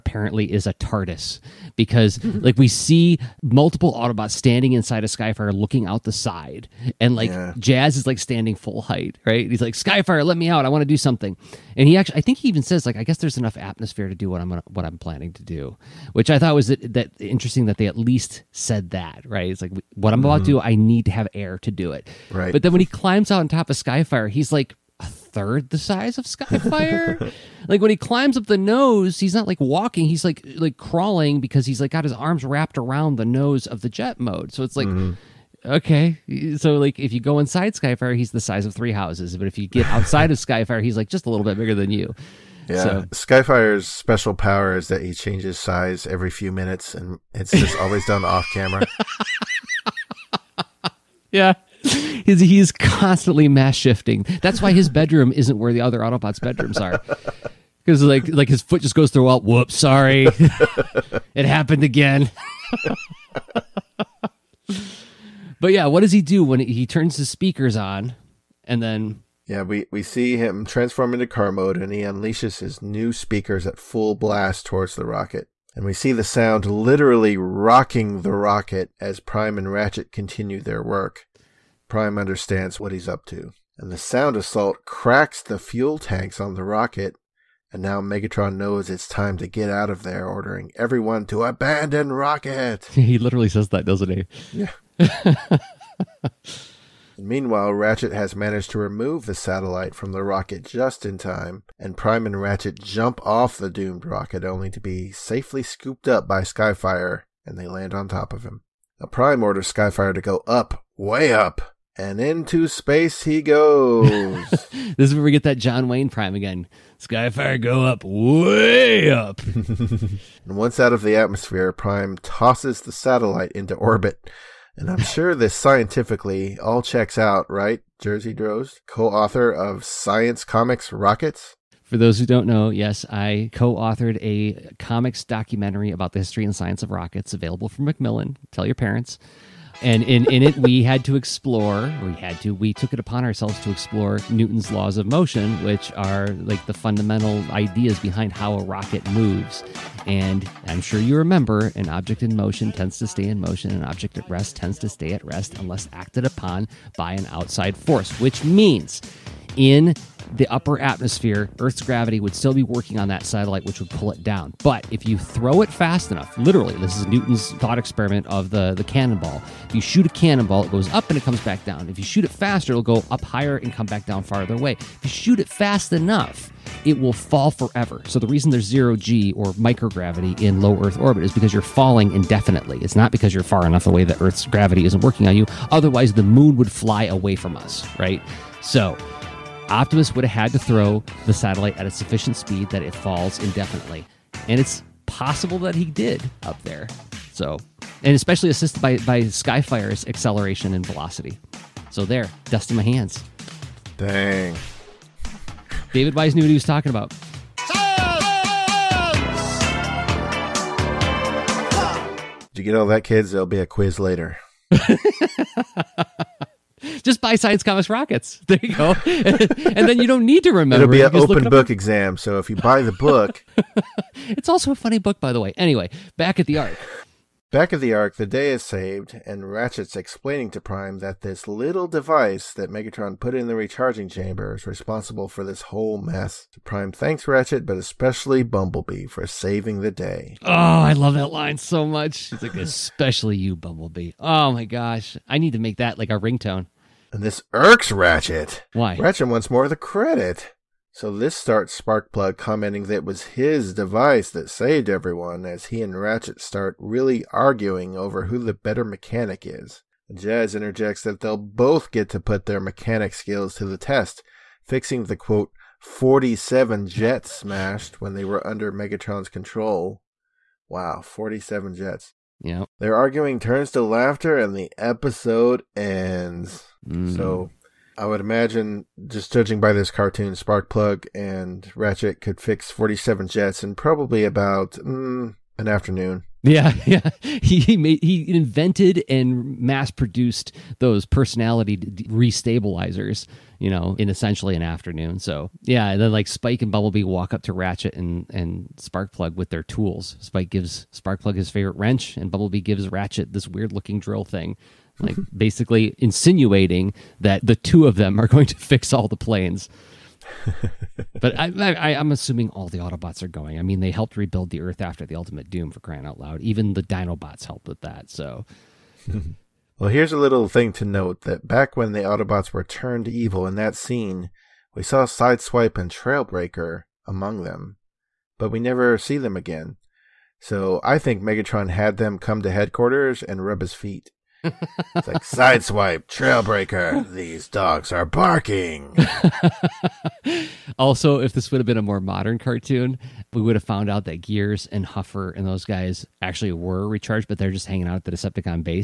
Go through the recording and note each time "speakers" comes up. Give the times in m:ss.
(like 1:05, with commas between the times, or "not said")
1:07, 1:13.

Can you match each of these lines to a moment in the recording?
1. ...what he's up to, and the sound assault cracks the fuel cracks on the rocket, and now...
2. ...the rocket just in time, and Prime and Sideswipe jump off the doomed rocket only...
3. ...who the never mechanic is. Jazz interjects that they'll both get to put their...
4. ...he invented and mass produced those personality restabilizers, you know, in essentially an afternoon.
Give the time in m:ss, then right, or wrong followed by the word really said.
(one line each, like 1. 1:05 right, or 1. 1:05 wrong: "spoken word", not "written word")
1. 1:22 wrong: "tanks", not "cracks"
2. 1:40 wrong: "Ratchet", not "Sideswipe"
3. 4:18 wrong: "better", not "never"
4. 4:48 right.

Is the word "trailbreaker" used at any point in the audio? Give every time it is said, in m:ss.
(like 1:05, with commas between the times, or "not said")
5:25, 5:36.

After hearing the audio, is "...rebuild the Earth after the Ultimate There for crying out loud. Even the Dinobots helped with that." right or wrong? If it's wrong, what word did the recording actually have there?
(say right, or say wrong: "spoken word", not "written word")
wrong: "Doom", not "There".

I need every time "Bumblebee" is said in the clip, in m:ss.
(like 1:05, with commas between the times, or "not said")
3:58, 4:03, 4:56, 5:02.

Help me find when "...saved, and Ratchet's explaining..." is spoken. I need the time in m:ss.
3:48.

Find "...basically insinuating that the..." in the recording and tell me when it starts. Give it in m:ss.
5:05.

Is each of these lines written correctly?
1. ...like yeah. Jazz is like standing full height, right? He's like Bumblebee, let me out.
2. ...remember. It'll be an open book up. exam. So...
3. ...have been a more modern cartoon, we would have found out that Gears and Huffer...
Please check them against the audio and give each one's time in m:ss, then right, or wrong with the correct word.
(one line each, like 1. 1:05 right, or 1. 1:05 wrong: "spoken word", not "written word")
1. 0:07 wrong: "Skyfire", not "Bumblebee"
2. 3:40 right
3. 5:41 right.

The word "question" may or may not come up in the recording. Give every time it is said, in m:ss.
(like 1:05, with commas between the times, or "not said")
not said.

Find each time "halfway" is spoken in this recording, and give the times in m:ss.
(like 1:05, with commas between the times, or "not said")
not said.